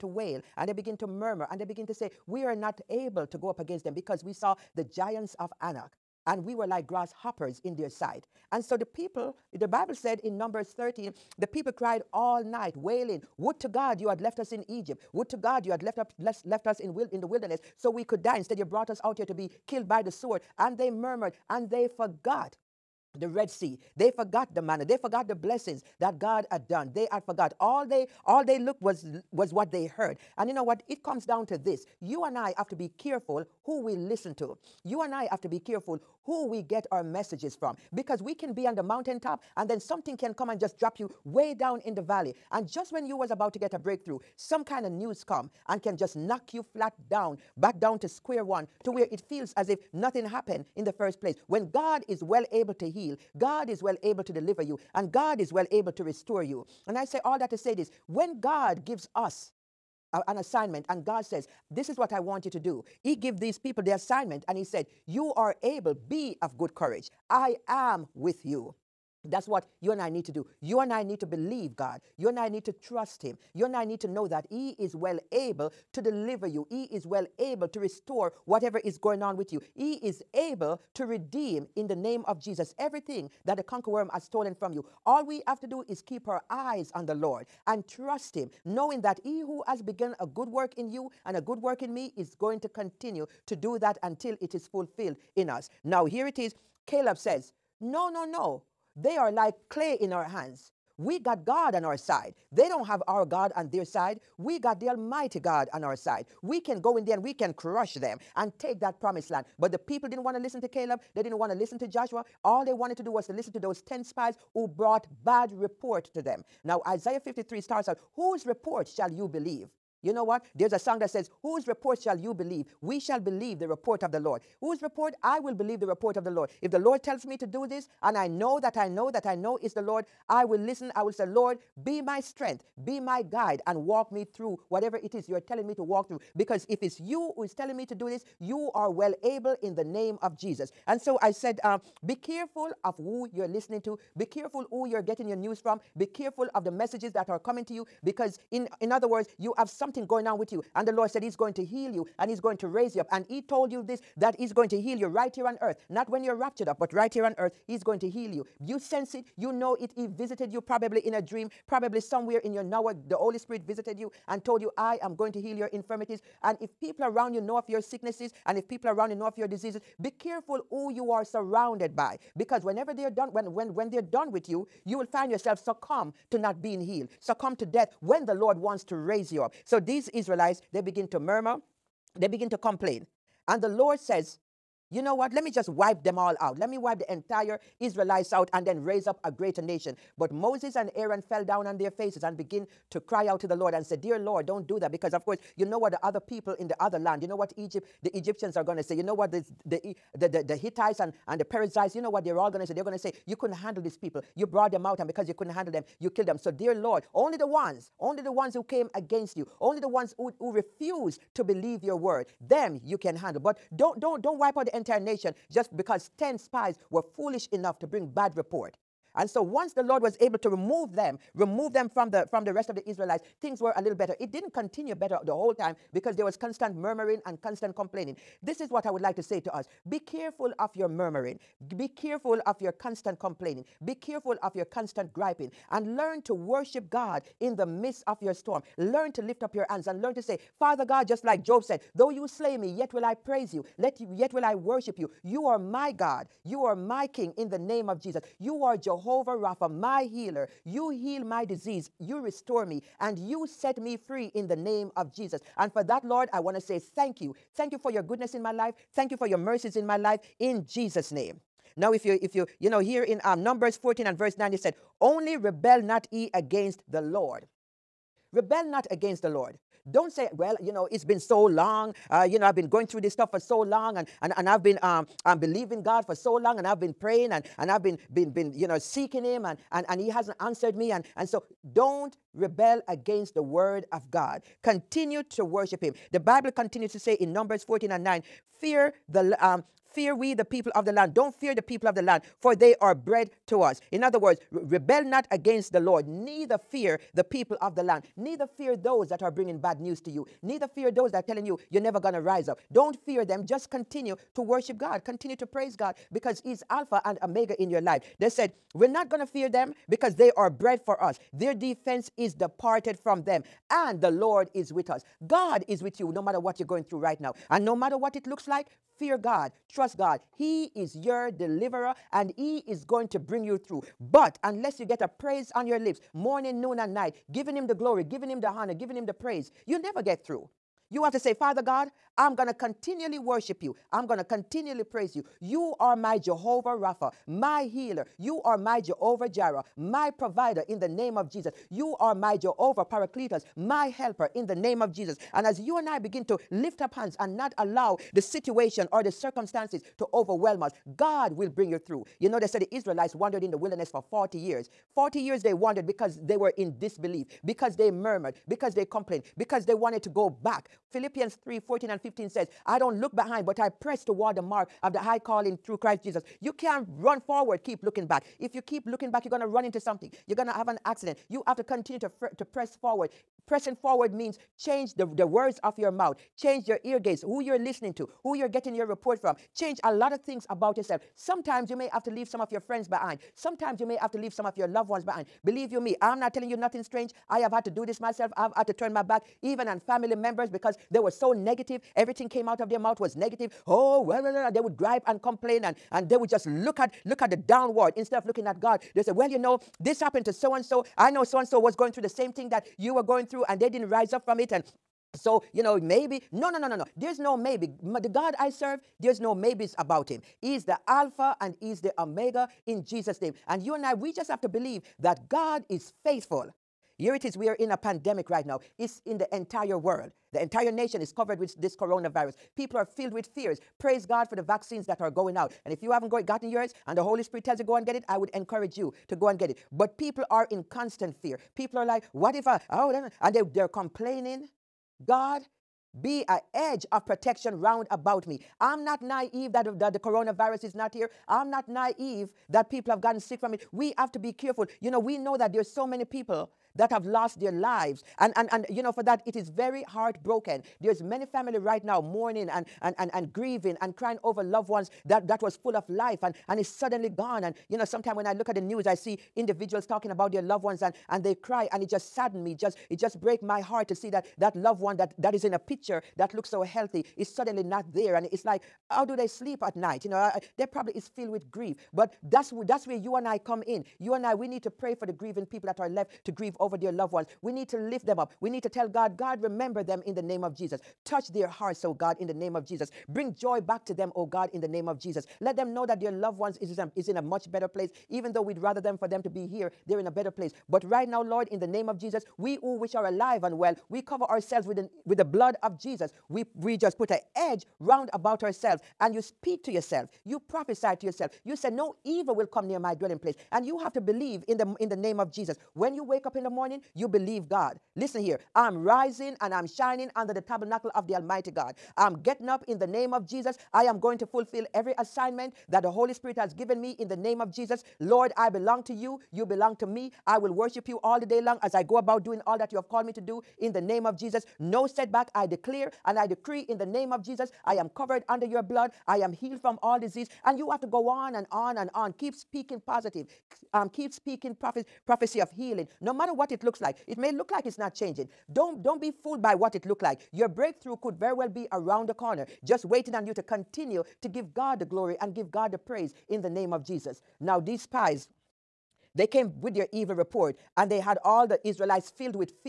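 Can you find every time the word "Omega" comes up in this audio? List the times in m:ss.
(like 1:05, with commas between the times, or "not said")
5:07, 6:51.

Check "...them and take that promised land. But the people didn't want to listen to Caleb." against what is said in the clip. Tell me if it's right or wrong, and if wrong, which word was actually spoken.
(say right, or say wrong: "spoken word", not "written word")
right.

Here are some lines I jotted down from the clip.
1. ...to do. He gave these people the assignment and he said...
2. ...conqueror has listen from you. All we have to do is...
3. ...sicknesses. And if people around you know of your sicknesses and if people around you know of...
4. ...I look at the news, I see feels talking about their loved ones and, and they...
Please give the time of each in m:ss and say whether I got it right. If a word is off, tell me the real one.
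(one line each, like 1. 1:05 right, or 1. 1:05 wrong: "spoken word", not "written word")
1. 1:02 right
2. 1:23 wrong: "stolen", not "listen"
3. 2:45 wrong: "infirmities", not "sicknesses"
4. 7:38 wrong: "individuals", not "feels".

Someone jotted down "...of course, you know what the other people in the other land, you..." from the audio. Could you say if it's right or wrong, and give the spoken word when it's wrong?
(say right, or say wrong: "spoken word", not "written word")
right.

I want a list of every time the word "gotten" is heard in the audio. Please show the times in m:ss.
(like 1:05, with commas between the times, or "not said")
7:06, 7:23.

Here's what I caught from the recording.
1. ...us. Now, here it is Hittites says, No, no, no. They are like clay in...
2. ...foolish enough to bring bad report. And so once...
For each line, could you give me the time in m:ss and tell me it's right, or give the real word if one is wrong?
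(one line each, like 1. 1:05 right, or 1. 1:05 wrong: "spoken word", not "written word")
1. 1:35 wrong: "Caleb", not "Hittites"
2. 3:37 right.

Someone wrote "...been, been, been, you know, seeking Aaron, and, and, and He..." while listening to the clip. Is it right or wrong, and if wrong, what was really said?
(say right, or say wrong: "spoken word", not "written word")
wrong: "Him", not "Aaron".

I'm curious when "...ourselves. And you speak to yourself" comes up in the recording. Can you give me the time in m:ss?
8:18.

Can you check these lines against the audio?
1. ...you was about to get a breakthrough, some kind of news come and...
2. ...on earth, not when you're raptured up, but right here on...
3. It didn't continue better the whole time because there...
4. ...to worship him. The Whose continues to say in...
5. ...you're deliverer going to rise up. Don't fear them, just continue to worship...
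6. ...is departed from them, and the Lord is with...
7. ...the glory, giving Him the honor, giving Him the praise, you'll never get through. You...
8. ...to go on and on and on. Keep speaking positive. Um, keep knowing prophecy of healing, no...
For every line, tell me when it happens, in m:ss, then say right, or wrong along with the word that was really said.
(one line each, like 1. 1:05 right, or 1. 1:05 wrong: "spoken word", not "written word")
1. 0:43 right
2. 2:35 right
3. 3:44 right
4. 4:45 wrong: "Bible", not "Whose"
5. 5:01 wrong: "never", not "deliverer"
6. 5:12 right
7. 5:27 right
8. 8:50 wrong: "speaking", not "knowing".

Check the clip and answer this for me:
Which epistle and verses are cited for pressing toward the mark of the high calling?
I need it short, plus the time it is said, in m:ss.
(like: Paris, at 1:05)
Philippians 3:14-15, at 6:00.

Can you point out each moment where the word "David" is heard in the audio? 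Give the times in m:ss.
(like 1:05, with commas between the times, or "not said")
not said.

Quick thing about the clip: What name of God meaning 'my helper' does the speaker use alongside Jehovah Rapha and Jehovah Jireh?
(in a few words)
Jehovah Paracletus.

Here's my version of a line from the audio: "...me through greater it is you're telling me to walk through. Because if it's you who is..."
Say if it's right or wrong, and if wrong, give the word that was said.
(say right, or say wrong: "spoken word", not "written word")
wrong: "whatever", not "greater".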